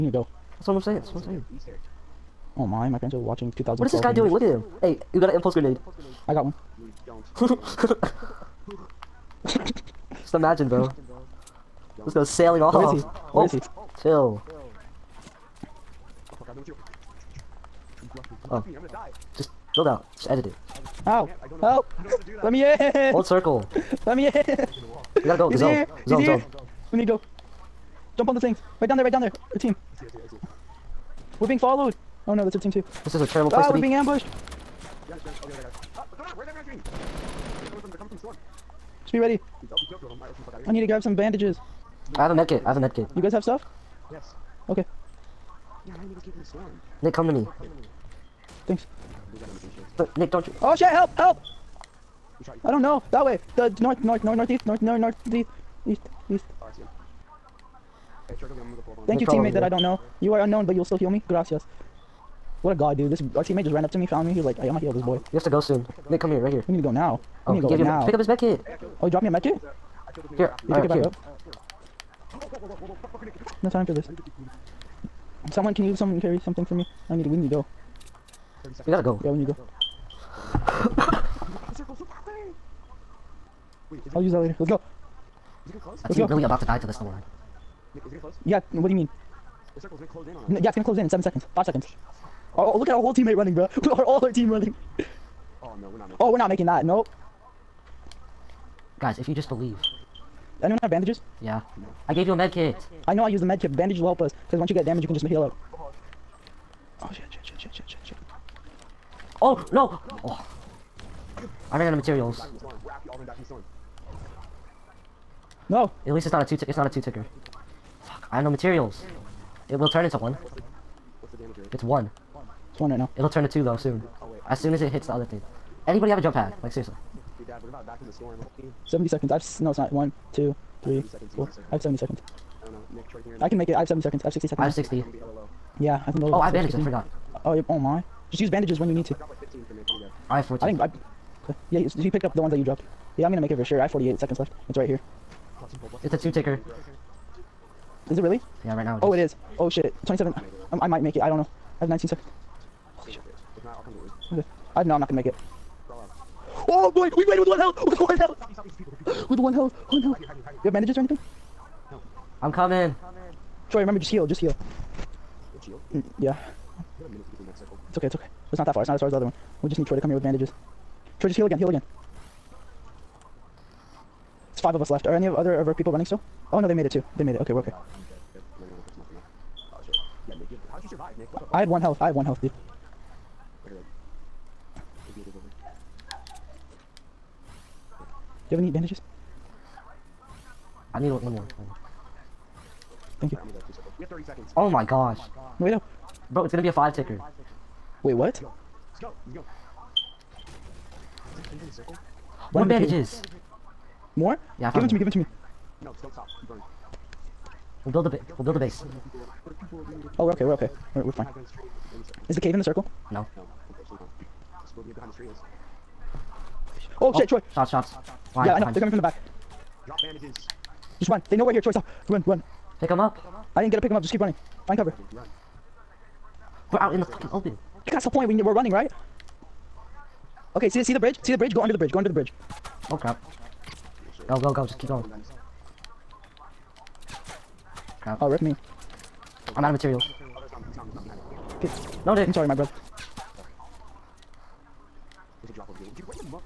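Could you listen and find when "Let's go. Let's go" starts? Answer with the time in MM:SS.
03:18.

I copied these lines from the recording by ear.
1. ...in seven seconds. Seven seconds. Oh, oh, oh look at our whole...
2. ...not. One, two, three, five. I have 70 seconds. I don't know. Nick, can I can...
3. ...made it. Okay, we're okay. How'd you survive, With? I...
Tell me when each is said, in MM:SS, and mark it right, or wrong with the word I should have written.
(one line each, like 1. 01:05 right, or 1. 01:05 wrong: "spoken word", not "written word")
1. 01:31 wrong: "Five", not "Seven"
2. 02:09 wrong: "four", not "five"
3. 02:57 wrong: "Nick", not "With".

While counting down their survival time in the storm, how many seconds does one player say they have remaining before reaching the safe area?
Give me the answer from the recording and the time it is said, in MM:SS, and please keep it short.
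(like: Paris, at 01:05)
48, at 02:23.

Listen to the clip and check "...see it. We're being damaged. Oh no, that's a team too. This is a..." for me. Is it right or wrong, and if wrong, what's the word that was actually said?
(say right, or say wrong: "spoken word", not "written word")
wrong: "followed", not "damaged".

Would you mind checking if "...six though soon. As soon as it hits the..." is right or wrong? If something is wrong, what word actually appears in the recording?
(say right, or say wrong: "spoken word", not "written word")
wrong: "two", not "six".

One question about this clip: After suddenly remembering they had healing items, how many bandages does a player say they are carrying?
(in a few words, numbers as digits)
14.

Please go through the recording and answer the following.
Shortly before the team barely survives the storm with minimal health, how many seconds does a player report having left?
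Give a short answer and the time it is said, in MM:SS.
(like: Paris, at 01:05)
19, at 02:31.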